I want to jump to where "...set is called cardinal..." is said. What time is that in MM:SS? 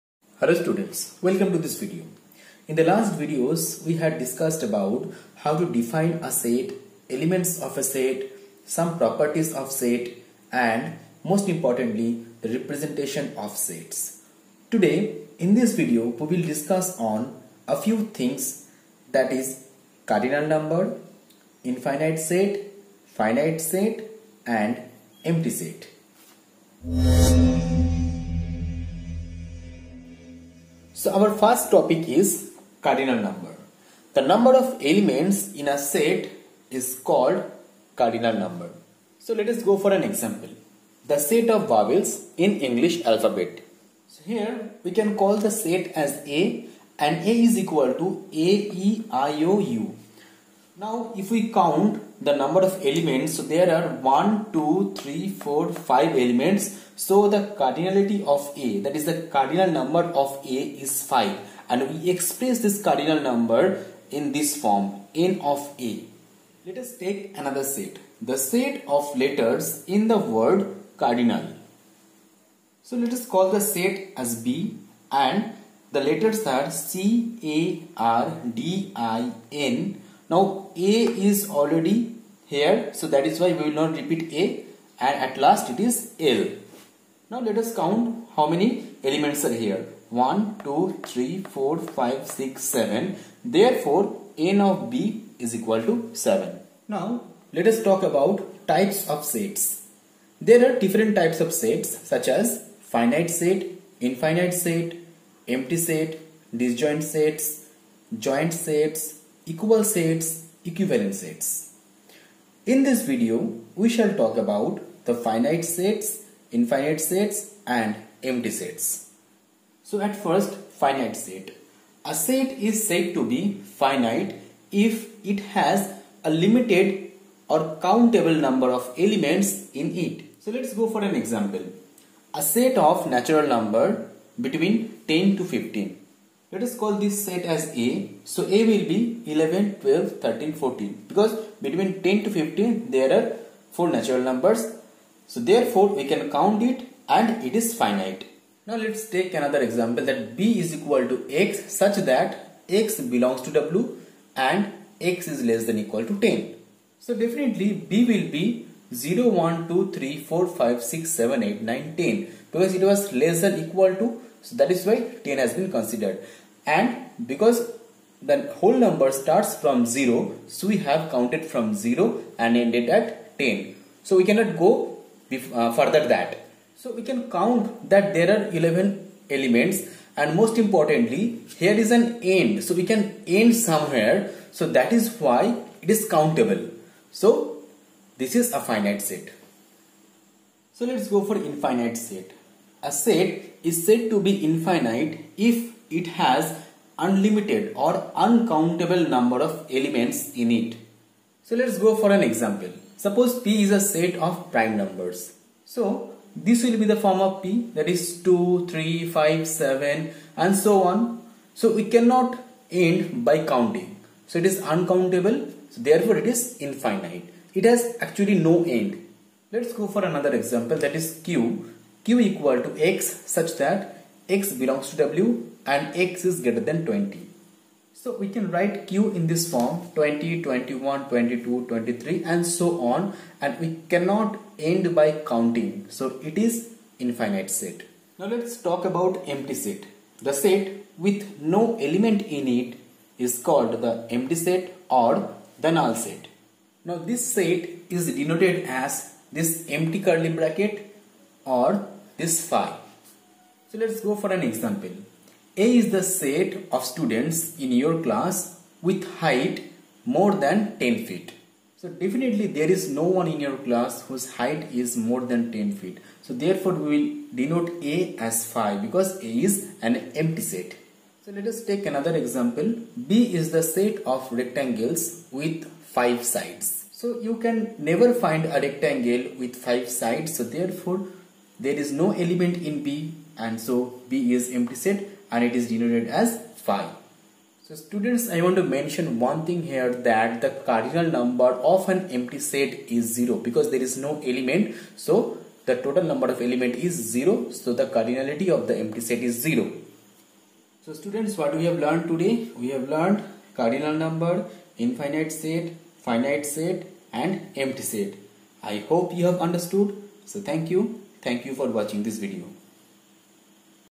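00:35.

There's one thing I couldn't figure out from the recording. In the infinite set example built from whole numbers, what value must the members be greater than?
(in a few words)
20.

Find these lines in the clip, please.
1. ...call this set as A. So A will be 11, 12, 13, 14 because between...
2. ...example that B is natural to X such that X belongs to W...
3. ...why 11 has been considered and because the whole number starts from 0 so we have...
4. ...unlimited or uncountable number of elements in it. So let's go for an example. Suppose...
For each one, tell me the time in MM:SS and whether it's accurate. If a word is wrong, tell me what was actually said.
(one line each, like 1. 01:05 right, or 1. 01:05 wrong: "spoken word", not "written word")
1. 02:16 right
2. 02:29 wrong: "equal", not "natural"
3. 02:44 wrong: "10", not "11"
4. 03:16 right.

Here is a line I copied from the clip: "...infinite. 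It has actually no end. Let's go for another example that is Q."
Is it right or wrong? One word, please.
right.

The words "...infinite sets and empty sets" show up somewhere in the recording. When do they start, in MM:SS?
01:56.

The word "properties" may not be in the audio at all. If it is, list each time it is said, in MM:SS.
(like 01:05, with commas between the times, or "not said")
00:08.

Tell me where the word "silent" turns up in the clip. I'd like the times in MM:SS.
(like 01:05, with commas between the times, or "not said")
not said.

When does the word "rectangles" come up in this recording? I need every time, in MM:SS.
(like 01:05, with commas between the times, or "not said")
04:34, 04:38.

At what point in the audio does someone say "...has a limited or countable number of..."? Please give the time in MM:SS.
02:05.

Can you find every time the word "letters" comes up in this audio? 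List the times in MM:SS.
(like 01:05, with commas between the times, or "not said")
01:09, 01:16.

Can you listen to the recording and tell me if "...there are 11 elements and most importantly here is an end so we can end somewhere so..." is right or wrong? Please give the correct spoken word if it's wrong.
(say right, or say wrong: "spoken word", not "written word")
right.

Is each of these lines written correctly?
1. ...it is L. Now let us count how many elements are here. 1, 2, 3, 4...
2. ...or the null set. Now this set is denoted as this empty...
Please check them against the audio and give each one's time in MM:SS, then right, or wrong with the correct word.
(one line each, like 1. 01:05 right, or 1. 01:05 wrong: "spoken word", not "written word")
1. 01:25 right
2. 04:04 right.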